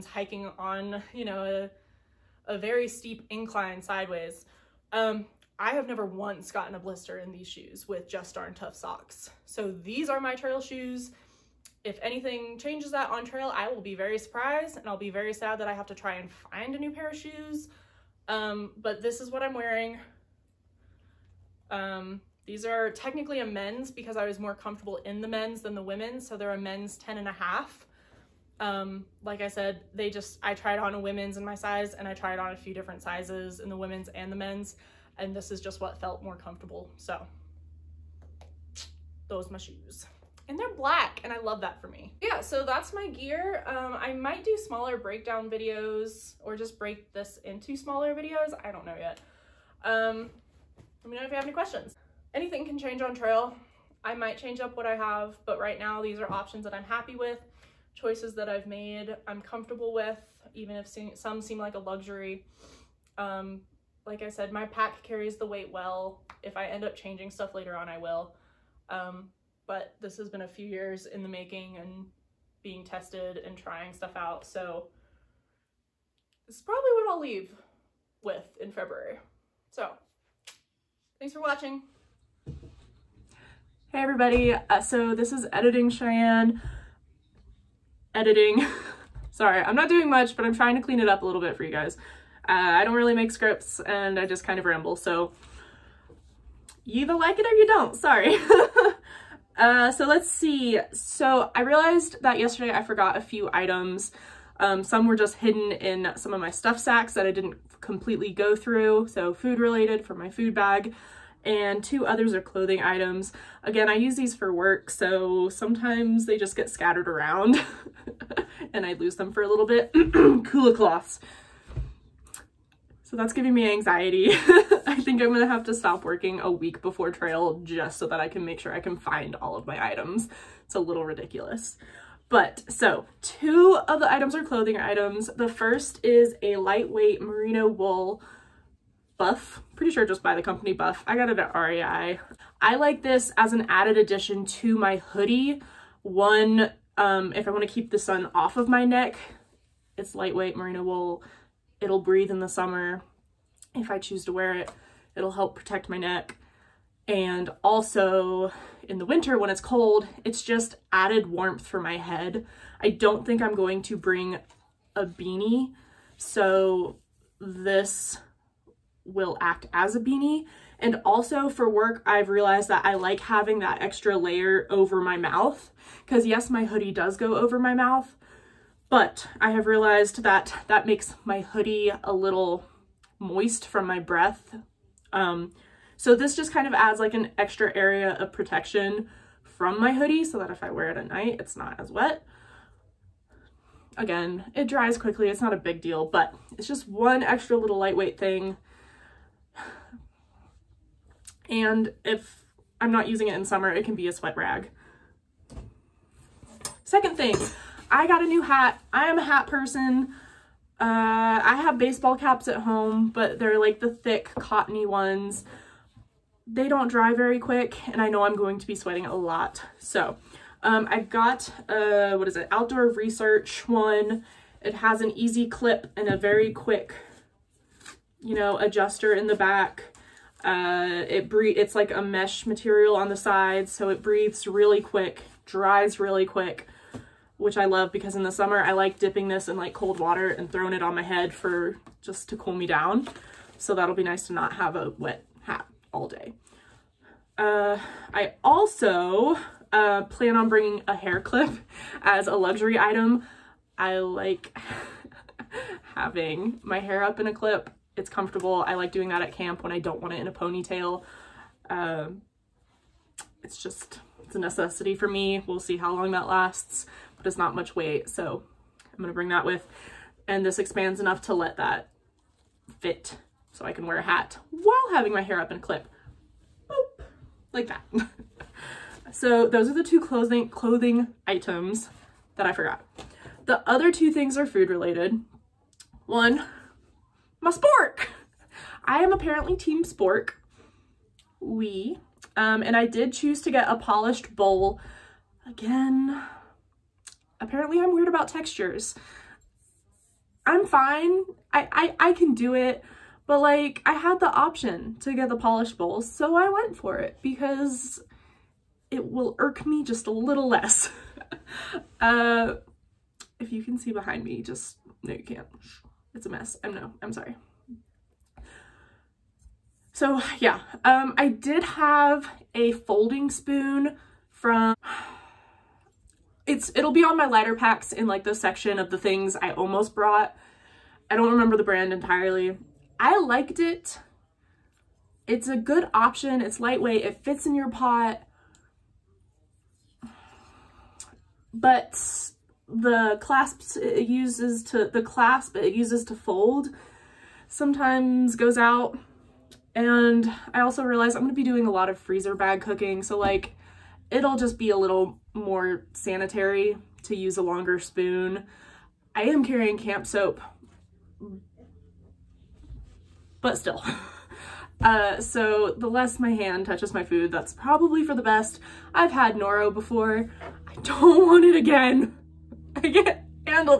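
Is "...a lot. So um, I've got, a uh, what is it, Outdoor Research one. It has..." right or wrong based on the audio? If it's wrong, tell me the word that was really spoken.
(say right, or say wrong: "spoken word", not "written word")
right.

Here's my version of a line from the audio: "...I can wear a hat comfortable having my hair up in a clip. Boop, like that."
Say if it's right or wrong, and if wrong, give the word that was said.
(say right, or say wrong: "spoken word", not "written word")
wrong: "while", not "comfortable".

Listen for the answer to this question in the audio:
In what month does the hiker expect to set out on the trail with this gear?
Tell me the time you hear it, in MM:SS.
01:18.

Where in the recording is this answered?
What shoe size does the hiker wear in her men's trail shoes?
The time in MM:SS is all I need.
00:26.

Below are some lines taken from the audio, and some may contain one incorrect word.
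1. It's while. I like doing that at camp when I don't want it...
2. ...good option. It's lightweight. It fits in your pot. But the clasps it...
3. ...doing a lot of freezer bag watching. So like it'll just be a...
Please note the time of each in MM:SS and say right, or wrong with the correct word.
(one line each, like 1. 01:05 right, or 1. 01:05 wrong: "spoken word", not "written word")
1. 04:17 wrong: "comfortable", not "while"
2. 05:35 right
3. 05:51 wrong: "cooking", not "watching".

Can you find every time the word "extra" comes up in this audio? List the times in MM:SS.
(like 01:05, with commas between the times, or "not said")
02:53, 03:07, 03:17.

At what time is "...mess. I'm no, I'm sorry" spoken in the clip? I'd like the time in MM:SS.
05:16.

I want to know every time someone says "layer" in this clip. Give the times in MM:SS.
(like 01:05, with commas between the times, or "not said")
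02:54.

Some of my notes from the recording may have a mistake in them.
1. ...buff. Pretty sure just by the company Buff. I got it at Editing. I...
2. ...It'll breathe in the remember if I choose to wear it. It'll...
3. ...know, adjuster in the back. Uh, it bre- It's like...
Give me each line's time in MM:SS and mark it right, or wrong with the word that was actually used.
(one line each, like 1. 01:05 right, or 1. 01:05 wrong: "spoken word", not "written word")
1. 02:19 wrong: "REI", not "Editing"
2. 02:31 wrong: "summer", not "remember"
3. 03:48 right.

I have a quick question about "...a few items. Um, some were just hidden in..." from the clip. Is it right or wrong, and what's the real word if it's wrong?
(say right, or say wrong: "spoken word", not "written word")
right.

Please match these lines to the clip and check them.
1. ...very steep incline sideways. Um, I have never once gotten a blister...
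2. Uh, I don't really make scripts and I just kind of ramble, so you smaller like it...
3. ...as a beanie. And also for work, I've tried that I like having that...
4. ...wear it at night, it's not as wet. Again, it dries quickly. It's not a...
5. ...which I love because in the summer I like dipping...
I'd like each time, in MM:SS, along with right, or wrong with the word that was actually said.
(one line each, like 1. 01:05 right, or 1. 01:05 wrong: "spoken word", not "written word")
1. 00:02 right
2. 01:32 wrong: "either", not "smaller"
3. 02:49 wrong: "realized", not "tried"
4. 03:10 right
5. 03:57 right.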